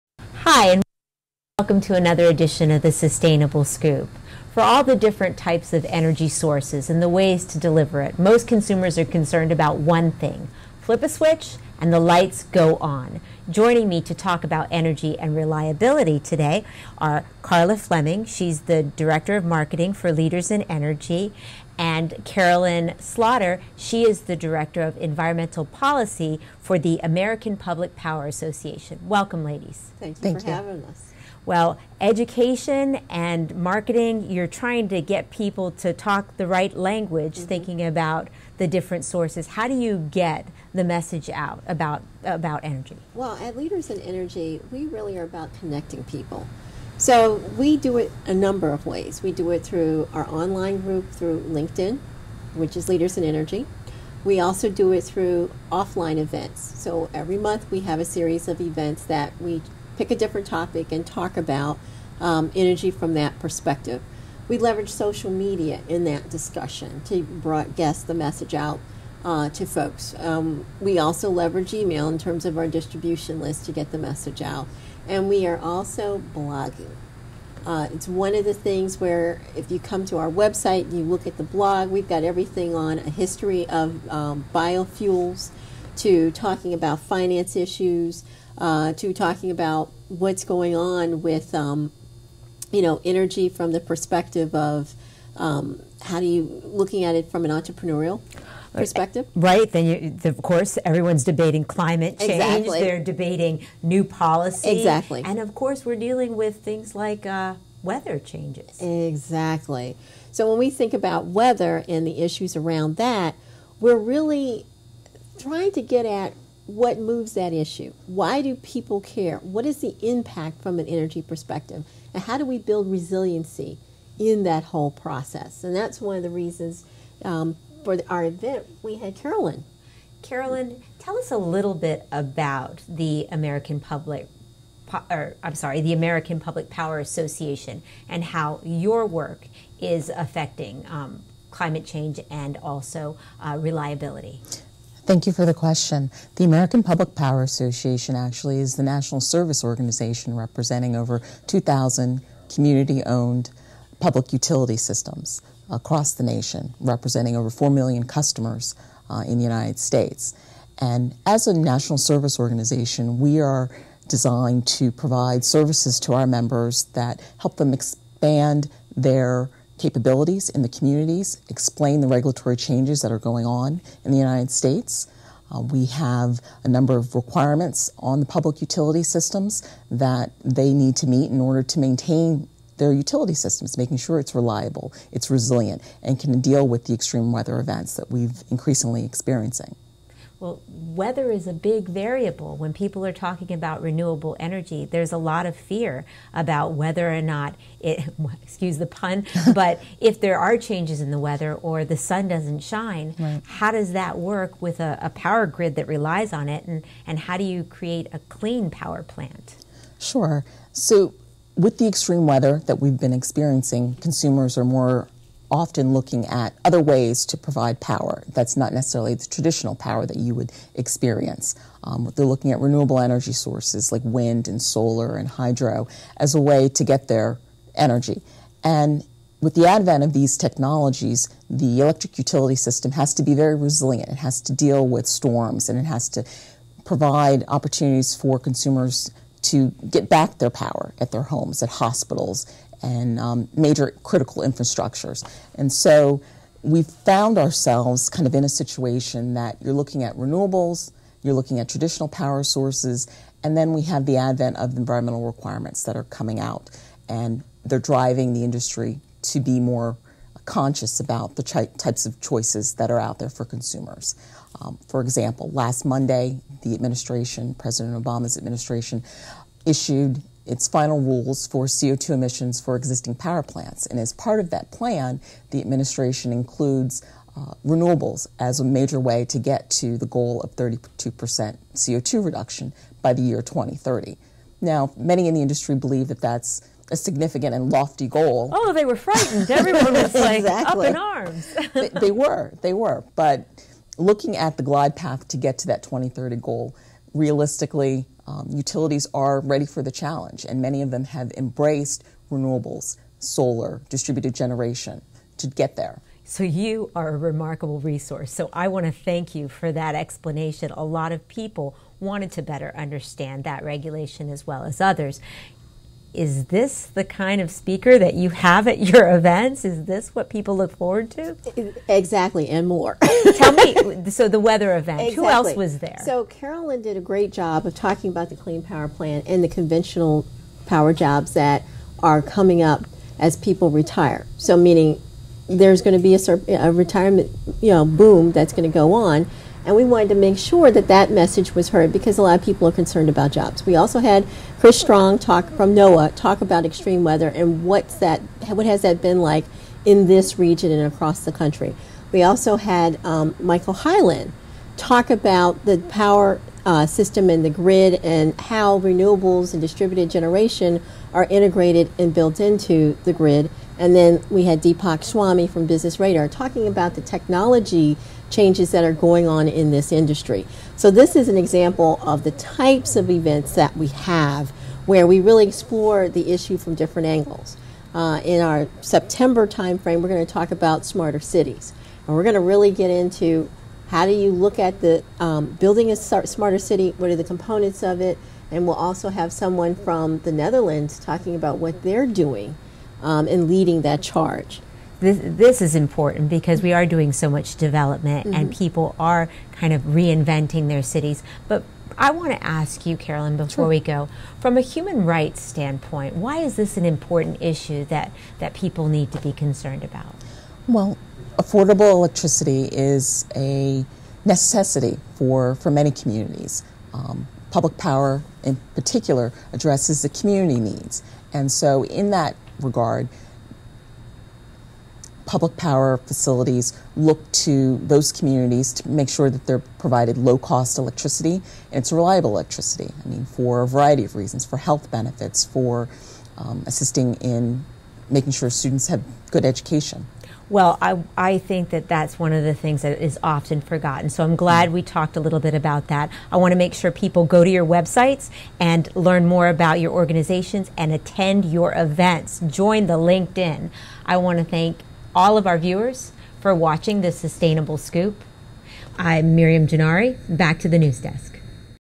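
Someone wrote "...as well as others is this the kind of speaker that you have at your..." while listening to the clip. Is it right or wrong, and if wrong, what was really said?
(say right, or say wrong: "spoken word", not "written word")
right.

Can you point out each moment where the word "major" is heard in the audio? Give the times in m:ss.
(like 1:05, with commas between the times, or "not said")
4:03, 4:38.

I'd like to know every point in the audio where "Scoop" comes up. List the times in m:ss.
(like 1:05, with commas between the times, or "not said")
0:03, 7:37.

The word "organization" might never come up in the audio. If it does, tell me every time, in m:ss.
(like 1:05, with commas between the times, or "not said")
2:29, 2:42, 7:29.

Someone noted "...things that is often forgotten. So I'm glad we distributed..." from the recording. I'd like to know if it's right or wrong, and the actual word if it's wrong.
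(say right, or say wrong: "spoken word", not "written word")
wrong: "talked", not "distributed".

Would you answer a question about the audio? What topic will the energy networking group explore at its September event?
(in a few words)
smarter cities.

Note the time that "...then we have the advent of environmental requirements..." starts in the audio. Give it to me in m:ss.
4:13.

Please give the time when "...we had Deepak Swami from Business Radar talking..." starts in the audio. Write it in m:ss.
6:04.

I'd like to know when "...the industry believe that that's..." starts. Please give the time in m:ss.
4:45.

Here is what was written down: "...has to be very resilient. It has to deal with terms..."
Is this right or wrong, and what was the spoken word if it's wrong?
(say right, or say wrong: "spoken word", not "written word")
wrong: "storms", not "terms".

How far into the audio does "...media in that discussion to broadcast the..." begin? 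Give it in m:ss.
1:05.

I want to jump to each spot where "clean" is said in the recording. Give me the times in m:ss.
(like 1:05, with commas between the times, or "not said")
3:28, 5:28.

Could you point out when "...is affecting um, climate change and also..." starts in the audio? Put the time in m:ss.
2:19.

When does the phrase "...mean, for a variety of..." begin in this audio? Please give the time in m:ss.
7:13.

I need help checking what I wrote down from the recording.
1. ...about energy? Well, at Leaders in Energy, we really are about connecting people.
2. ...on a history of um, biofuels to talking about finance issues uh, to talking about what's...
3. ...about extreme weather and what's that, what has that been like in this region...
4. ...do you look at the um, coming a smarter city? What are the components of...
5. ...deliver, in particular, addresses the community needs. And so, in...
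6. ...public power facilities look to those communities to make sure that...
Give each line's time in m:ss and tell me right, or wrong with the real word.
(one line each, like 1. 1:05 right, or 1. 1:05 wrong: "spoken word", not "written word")
1. 0:42 right
2. 1:22 right
3. 5:46 right
4. 6:24 wrong: "building", not "coming"
5. 6:57 wrong: "power", not "deliver"
6. 7:05 right.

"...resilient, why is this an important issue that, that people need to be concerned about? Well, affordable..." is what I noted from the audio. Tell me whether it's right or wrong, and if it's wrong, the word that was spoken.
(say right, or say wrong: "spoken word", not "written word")
wrong: "standpoint", not "resilient".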